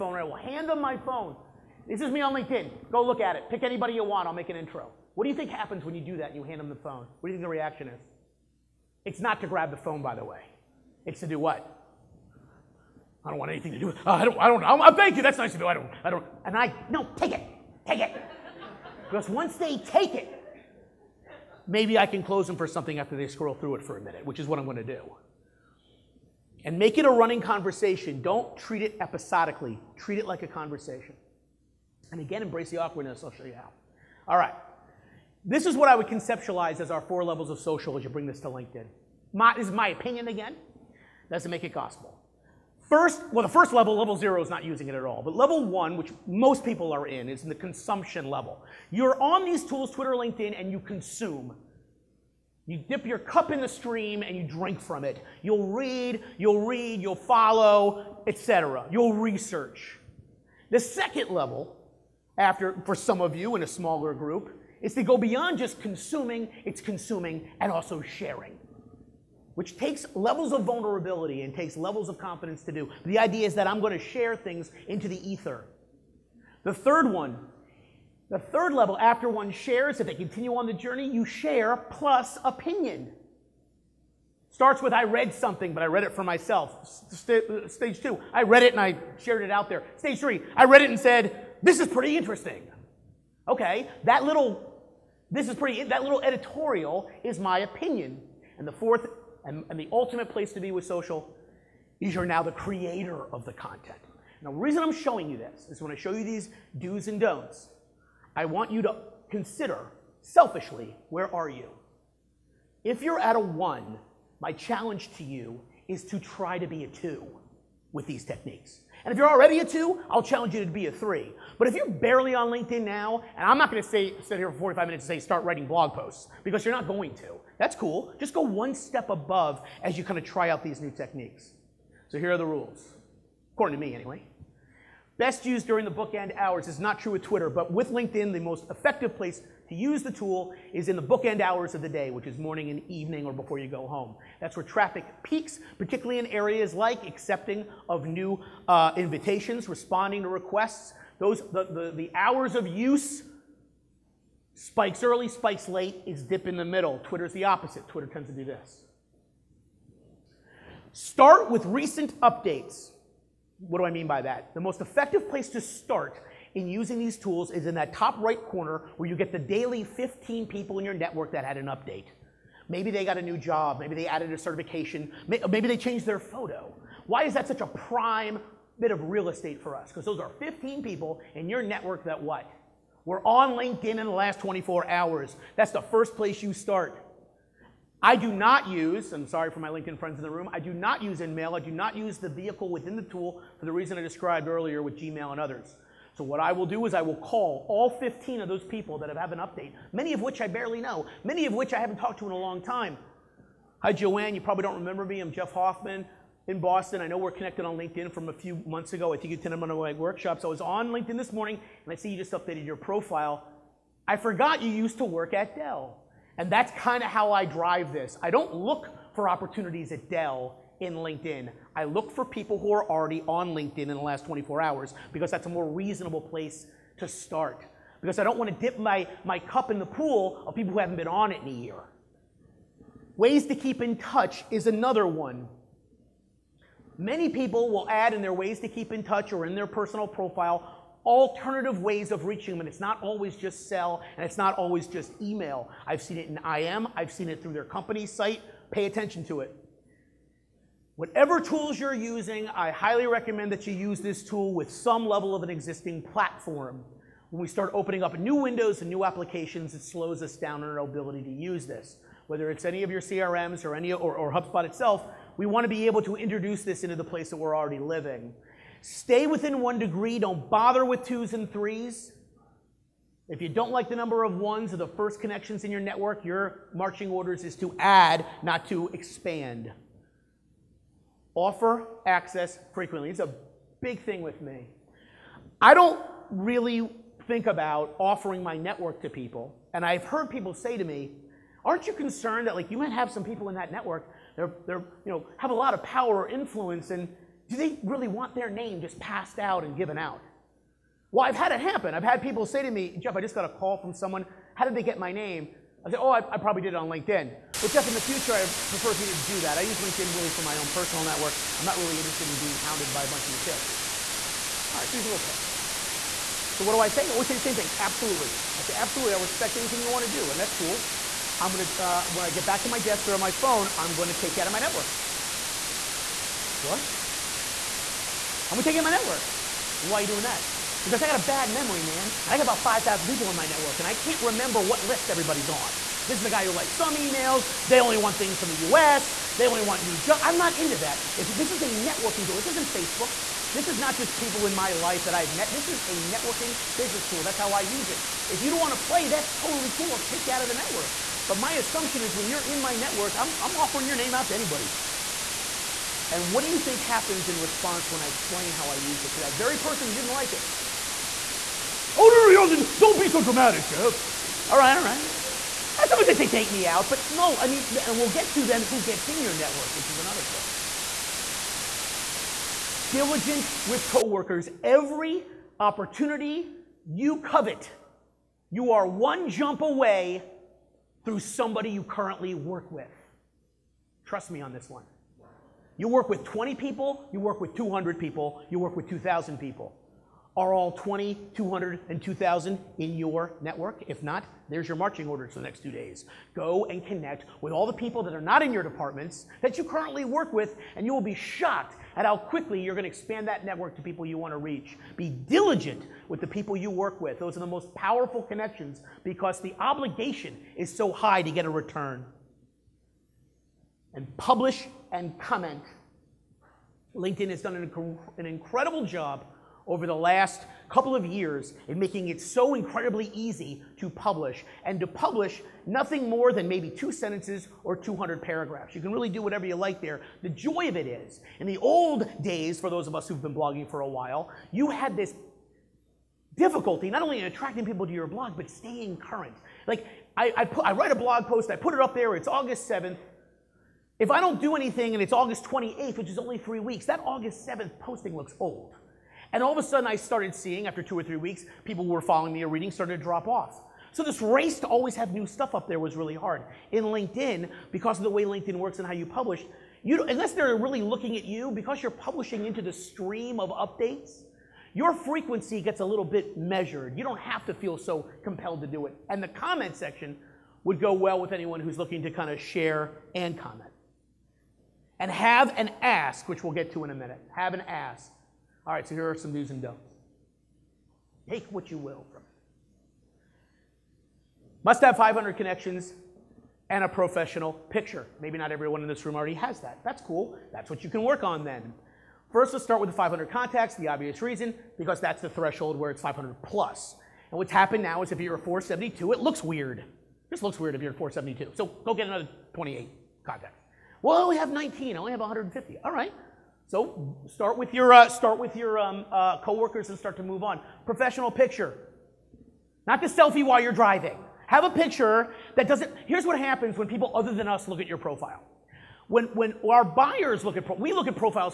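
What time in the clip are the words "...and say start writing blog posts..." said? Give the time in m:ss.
2:05.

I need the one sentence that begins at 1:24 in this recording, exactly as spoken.
Starts with I read something, but I read it for myself.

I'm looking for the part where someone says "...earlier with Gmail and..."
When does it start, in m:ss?
3:14.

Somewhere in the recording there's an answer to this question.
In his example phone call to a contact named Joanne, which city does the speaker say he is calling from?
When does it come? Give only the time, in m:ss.
3:26.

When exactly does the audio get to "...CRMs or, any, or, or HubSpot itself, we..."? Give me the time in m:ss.
4:22.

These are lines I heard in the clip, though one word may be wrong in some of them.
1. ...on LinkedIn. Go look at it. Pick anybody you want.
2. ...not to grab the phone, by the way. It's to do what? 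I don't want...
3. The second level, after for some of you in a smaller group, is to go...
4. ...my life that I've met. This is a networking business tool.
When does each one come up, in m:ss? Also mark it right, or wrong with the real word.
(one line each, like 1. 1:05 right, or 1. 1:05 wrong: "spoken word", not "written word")
1. 0:02 right
2. 0:09 right
3. 1:00 right
4. 5:44 right.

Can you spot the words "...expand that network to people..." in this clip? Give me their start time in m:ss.
6:42.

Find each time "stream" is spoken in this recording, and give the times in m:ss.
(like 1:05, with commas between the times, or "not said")
0:53, 7:42.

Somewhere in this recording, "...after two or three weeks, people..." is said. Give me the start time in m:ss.
7:30.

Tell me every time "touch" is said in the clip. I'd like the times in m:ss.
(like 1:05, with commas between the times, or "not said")
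3:53, 3:59.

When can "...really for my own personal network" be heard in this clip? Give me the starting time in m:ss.
5:10.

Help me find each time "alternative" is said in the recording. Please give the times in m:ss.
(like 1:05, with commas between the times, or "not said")
4:01.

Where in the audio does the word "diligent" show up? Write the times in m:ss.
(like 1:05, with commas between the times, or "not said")
6:12, 6:45.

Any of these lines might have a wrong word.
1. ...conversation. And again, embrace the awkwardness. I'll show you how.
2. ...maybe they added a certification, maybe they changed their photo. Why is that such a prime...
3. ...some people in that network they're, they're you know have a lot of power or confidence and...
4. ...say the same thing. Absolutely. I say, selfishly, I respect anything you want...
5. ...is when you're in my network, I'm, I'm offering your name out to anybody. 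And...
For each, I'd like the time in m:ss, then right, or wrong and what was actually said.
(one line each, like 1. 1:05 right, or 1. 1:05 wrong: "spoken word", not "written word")
1. 0:30 right
2. 2:53 right
3. 4:53 wrong: "influence", not "confidence"
4. 5:17 wrong: "absolutely", not "selfishly"
5. 5:52 right.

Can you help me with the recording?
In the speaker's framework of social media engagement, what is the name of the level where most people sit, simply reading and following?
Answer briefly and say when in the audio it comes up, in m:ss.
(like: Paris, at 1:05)
consumption level, at 0:47.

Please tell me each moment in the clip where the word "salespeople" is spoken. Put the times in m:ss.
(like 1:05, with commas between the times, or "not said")
5:13.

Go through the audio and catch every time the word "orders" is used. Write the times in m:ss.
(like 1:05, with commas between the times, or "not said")
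4:37, 6:35.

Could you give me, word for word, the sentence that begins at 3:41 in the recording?
I look for people who are already on LinkedIn in the last 24 hours because that's a more reasonable place to start.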